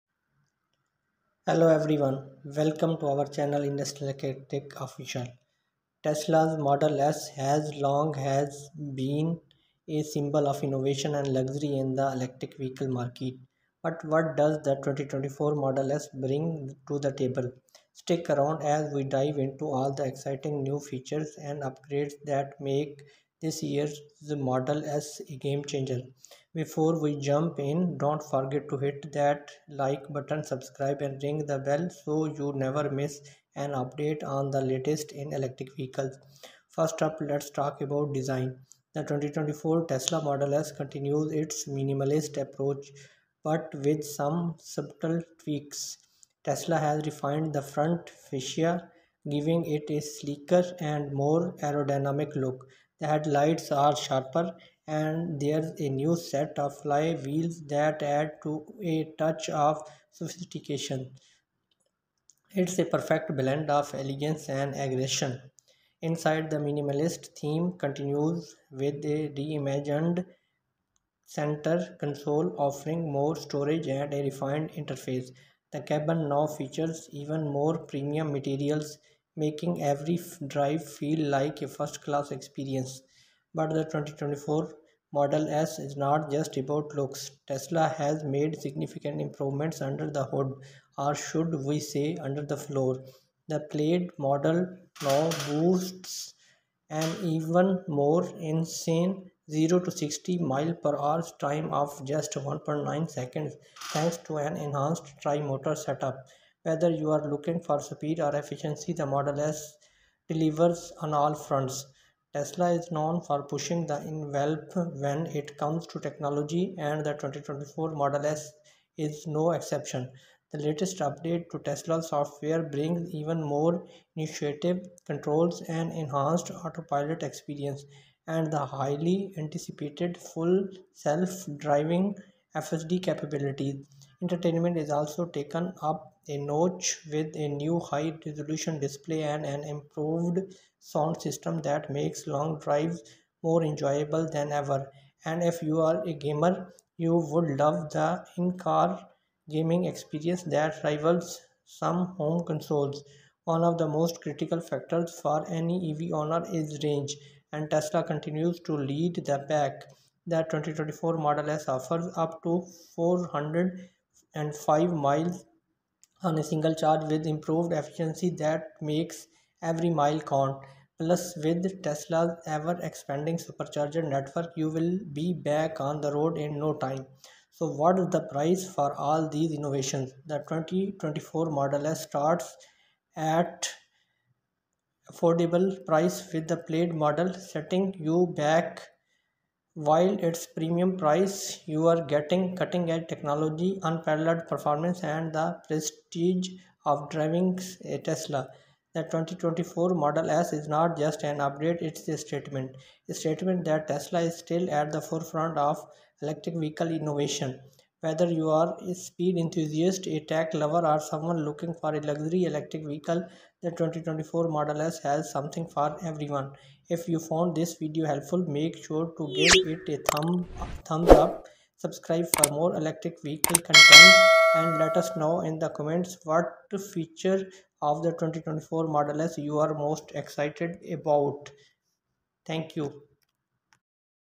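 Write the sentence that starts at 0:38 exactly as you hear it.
The 2024 Tesla Model S continues its minimalist approach but with some subtle tweaks.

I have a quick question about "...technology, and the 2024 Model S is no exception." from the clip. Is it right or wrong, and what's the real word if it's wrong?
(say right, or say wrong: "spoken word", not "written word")
right.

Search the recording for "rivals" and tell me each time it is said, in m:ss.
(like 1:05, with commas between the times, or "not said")
2:30.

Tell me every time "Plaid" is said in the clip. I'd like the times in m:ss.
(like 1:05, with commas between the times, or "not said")
1:33, 3:06.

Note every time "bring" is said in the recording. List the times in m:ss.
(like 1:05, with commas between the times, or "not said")
0:16, 2:02.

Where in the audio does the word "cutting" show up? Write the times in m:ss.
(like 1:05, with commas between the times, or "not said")
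3:12.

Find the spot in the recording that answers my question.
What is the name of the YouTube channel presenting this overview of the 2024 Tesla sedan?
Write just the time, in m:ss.
0:03.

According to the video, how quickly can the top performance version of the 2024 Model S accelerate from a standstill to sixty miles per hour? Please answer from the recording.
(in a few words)
1.9 seconds.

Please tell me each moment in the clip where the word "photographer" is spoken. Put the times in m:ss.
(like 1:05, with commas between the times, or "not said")
not said.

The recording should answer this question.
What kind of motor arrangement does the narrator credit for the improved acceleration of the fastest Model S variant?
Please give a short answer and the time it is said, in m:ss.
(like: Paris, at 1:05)
tri-motor setup, at 1:45.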